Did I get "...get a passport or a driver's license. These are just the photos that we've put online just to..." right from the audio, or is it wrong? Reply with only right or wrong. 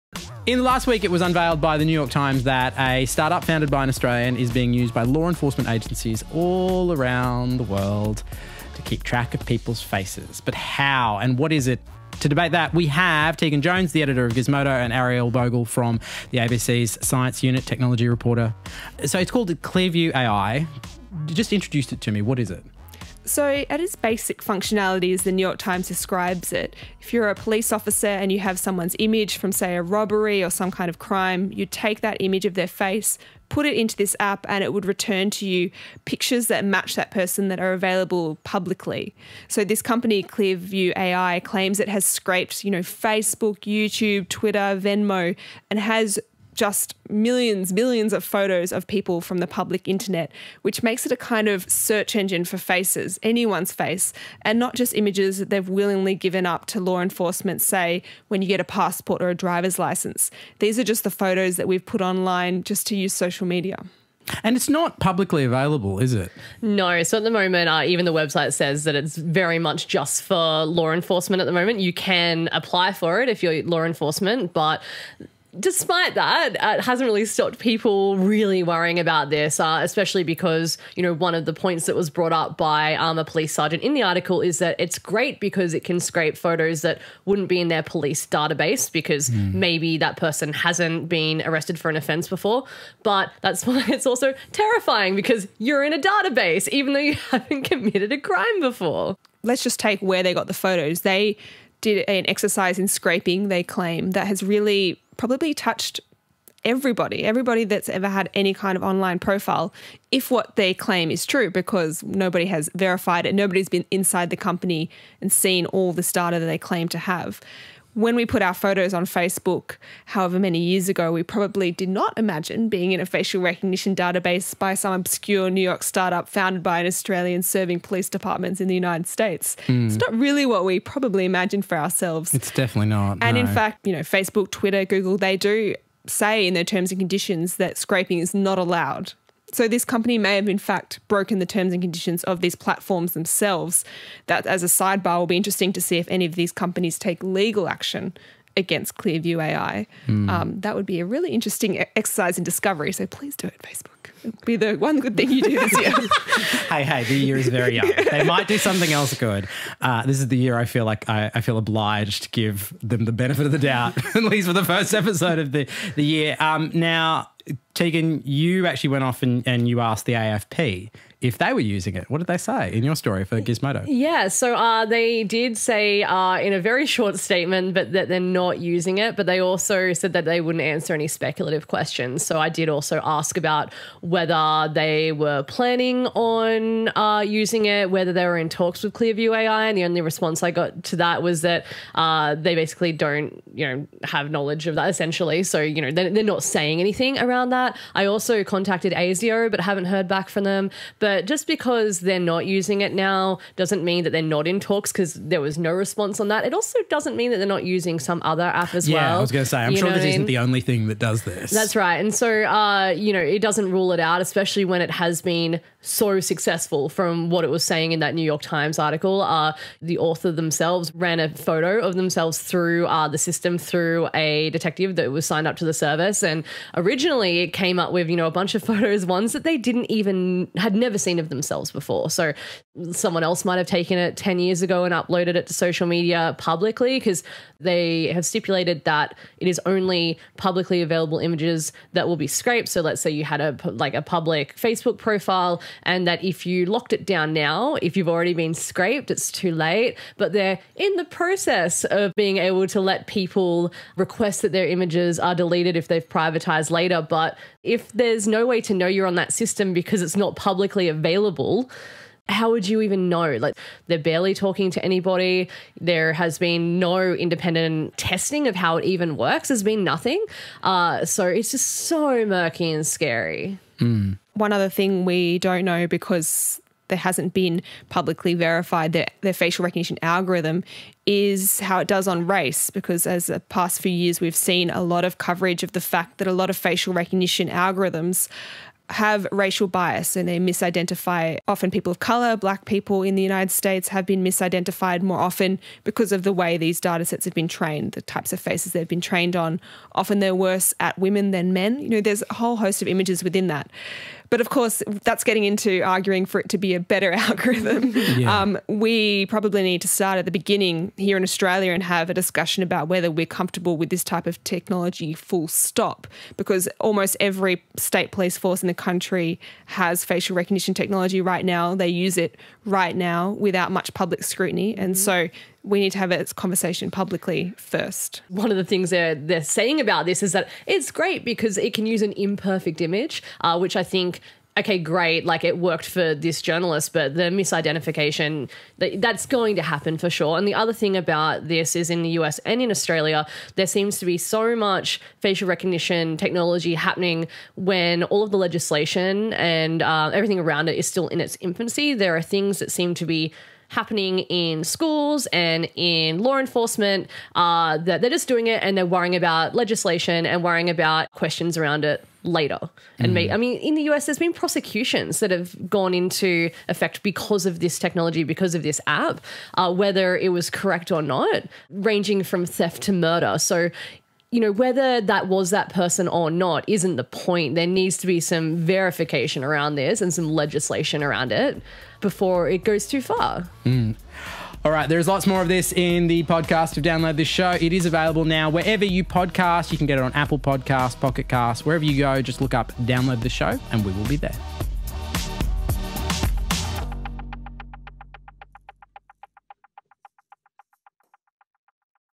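right.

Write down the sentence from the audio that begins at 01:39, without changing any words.
Let's just take where they got the photos.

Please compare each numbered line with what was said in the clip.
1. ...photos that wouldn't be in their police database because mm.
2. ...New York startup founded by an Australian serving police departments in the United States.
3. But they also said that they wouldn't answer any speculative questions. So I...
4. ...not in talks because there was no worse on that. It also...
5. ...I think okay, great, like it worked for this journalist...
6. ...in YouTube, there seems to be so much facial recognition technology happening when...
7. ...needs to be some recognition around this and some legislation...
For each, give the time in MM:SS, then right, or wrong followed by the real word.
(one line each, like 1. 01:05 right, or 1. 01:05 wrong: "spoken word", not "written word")
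1. 01:26 right
2. 02:05 right
3. 02:59 right
4. 03:24 wrong: "response", not "worse"
5. 05:33 right
6. 05:42 wrong: "Australia", not "YouTube"
7. 06:17 wrong: "verification", not "recognition".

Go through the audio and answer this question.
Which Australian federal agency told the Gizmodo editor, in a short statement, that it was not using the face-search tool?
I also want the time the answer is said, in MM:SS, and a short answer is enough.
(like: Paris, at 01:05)
AFP, at 02:50.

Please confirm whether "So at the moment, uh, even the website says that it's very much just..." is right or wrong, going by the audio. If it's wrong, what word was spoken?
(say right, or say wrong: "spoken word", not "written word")
right.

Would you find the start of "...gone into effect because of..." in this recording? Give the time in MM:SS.
06:05.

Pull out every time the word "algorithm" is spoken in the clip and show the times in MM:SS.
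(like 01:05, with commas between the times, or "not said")
04:40, 04:47, 05:07.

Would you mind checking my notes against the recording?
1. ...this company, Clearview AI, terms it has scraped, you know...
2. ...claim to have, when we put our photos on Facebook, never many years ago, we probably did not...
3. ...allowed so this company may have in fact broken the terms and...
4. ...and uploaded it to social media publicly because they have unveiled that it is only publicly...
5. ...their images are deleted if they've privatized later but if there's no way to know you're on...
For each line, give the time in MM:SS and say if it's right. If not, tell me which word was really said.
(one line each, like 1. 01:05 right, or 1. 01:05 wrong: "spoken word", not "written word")
1. 00:39 wrong: "claims", not "terms"
2. 01:56 wrong: "however", not "never"
3. 02:18 right
4. 03:54 wrong: "stipulated", not "unveiled"
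5. 04:14 right.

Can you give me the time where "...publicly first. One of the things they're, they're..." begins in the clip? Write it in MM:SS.
05:26.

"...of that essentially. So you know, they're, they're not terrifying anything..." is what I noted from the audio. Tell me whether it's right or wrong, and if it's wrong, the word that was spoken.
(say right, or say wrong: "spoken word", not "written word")
wrong: "saying", not "terrifying".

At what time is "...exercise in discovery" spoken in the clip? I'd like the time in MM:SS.
02:31.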